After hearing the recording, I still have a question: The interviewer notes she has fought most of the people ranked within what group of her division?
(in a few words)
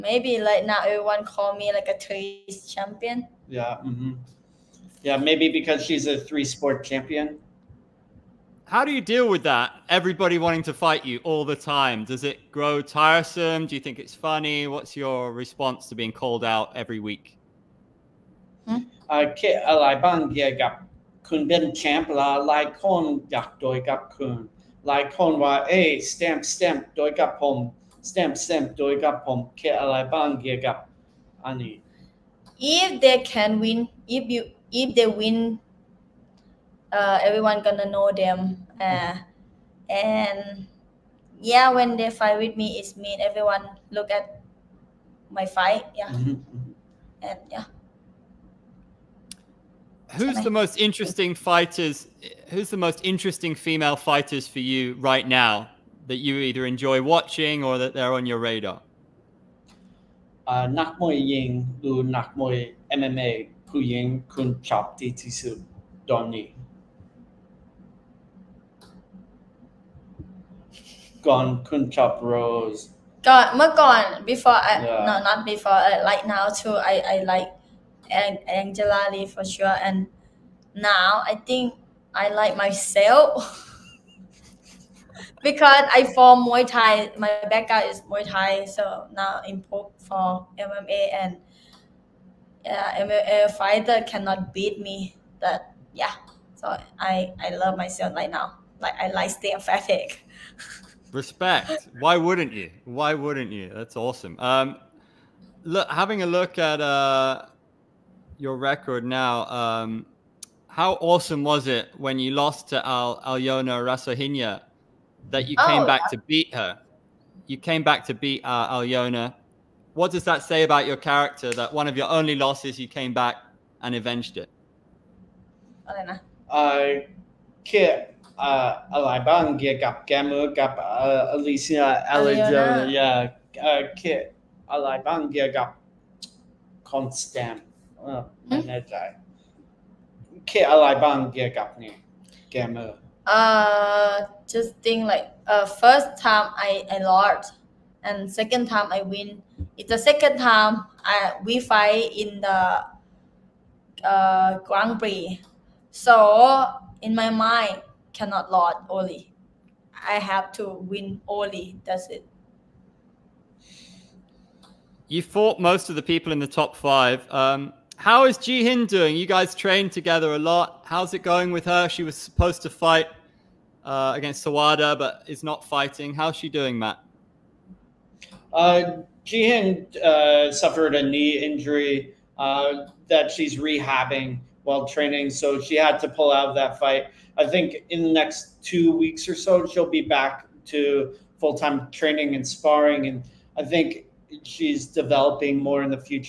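top 5.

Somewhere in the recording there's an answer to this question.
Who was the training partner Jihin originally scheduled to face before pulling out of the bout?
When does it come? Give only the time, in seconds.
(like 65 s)
174 s.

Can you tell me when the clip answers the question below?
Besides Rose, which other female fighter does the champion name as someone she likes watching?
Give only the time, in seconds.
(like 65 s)
78 s.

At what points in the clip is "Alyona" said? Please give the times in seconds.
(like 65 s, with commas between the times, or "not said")
113 s, 118 s, 132 s.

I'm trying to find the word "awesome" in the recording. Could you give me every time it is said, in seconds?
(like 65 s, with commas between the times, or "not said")
103 s, 110 s.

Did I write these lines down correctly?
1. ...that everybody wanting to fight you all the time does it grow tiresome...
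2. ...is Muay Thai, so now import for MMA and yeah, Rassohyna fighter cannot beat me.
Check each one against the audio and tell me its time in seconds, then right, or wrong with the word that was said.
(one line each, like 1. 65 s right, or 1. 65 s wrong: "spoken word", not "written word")
1. 9 s right
2. 87 s wrong: "MMA", not "Rassohyna".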